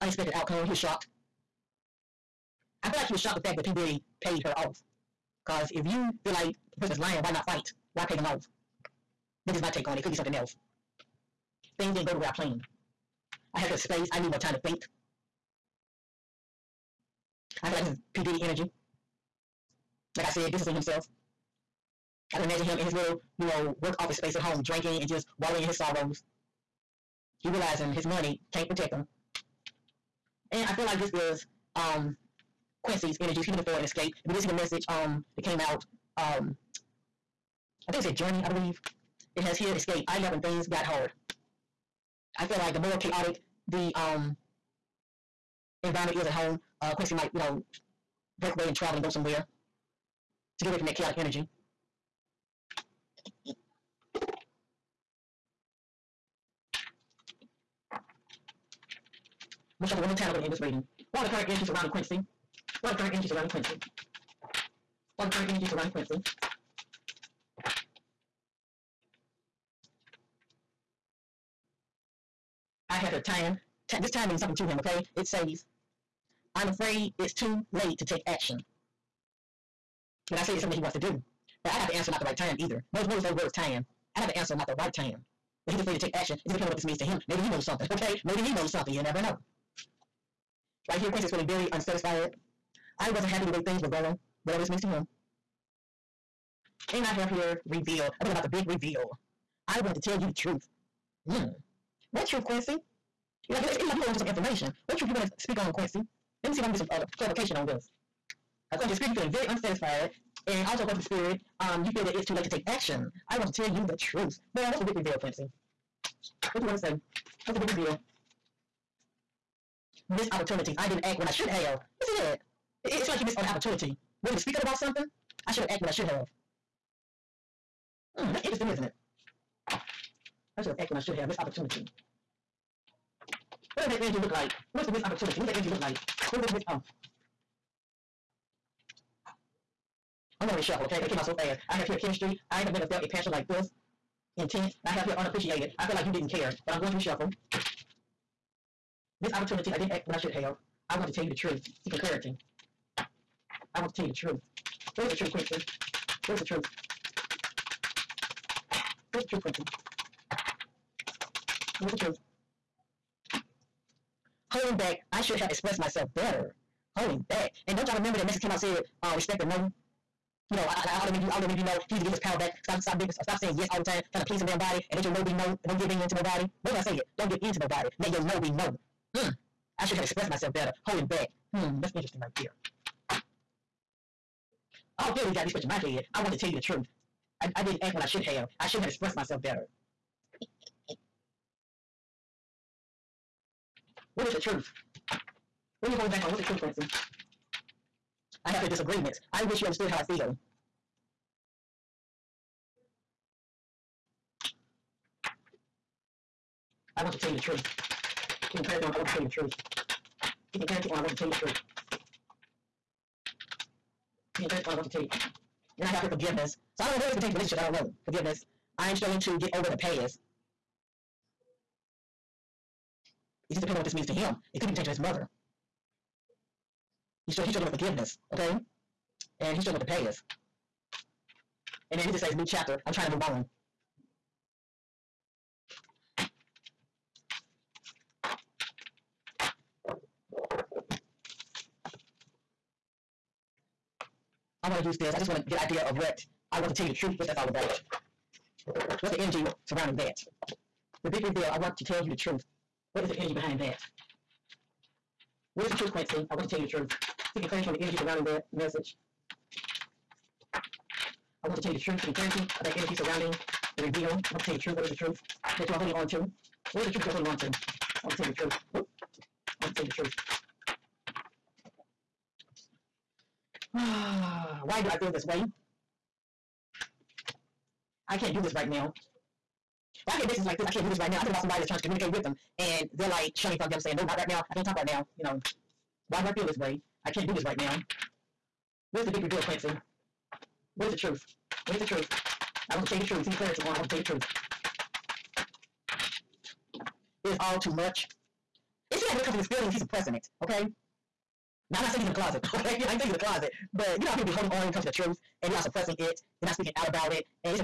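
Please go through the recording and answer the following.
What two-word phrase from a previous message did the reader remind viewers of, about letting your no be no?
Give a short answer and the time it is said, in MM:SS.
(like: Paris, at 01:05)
Respect the no, at 02:49.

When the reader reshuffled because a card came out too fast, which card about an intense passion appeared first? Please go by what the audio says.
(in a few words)
Chemistry.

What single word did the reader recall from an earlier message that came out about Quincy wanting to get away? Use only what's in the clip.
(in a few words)
Journey.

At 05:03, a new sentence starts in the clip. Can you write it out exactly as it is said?
But you know how people be holding on when it comes to the truth and they are suppressing it.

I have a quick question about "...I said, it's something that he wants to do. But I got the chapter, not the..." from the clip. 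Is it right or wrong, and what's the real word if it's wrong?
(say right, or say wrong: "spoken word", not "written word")
wrong: "answer", not "chapter".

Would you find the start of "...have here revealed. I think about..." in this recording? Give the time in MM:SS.
01:37.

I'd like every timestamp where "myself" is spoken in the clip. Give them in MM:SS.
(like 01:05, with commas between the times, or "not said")
02:45, 03:00, 03:09.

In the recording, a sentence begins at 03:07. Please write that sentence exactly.
I, I didn't act when I should have.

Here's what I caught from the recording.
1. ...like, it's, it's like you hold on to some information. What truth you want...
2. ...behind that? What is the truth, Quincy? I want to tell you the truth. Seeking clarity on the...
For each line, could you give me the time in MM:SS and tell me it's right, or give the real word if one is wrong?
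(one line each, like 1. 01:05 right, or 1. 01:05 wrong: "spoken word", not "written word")
1. 01:43 right
2. 04:13 right.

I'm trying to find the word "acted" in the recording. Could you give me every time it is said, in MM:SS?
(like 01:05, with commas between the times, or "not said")
02:05, 02:10.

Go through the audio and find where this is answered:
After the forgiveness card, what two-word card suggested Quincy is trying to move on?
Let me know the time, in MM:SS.
03:52.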